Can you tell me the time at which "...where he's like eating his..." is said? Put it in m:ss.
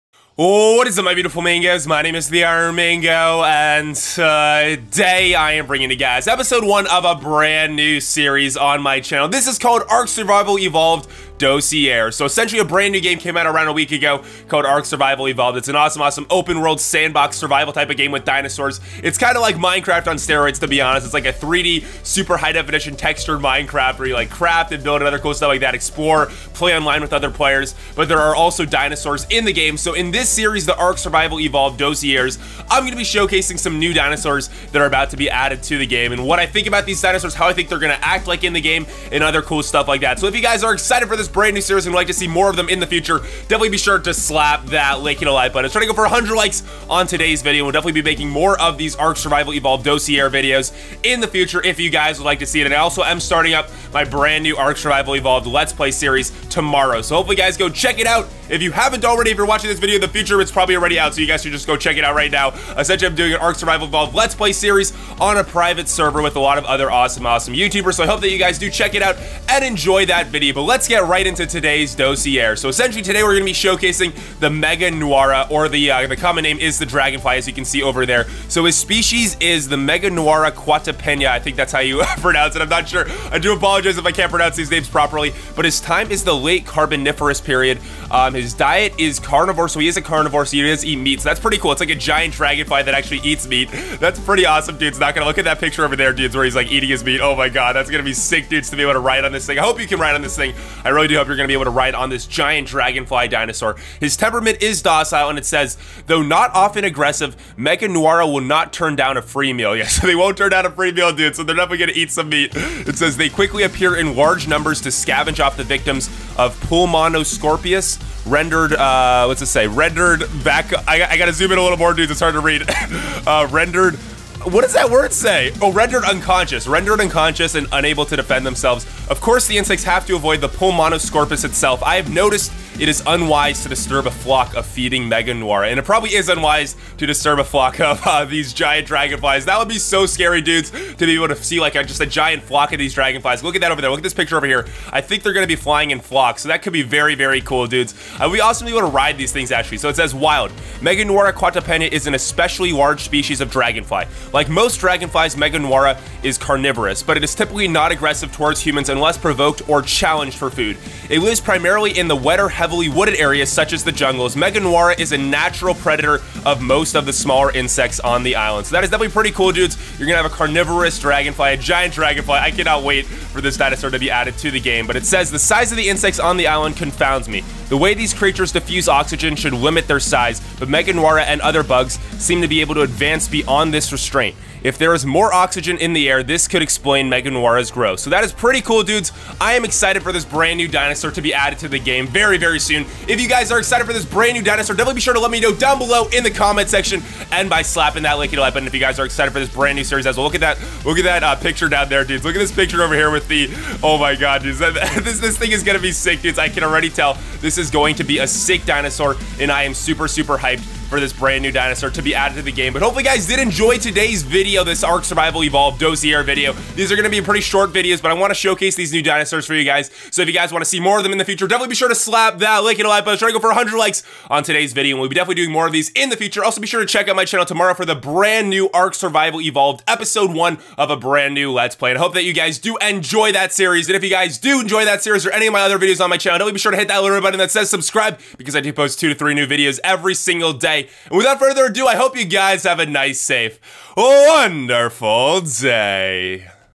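1:36.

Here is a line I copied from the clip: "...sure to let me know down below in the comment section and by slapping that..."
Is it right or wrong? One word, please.
right.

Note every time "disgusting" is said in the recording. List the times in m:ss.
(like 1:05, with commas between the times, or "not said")
not said.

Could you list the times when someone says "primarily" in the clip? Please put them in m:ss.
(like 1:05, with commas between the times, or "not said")
2:41.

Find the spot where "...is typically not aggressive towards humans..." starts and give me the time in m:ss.
2:37.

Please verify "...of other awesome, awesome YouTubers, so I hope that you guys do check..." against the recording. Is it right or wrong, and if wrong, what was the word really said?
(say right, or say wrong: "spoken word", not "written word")
right.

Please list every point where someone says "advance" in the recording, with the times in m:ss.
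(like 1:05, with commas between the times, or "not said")
3:02.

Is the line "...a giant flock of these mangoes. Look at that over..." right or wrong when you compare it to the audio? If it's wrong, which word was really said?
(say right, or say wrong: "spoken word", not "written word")
wrong: "dragonflies", not "mangoes".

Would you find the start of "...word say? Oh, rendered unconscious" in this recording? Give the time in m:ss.
2:04.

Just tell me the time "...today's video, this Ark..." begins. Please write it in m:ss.
3:33.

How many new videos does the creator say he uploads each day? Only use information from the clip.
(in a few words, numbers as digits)
2 to 3.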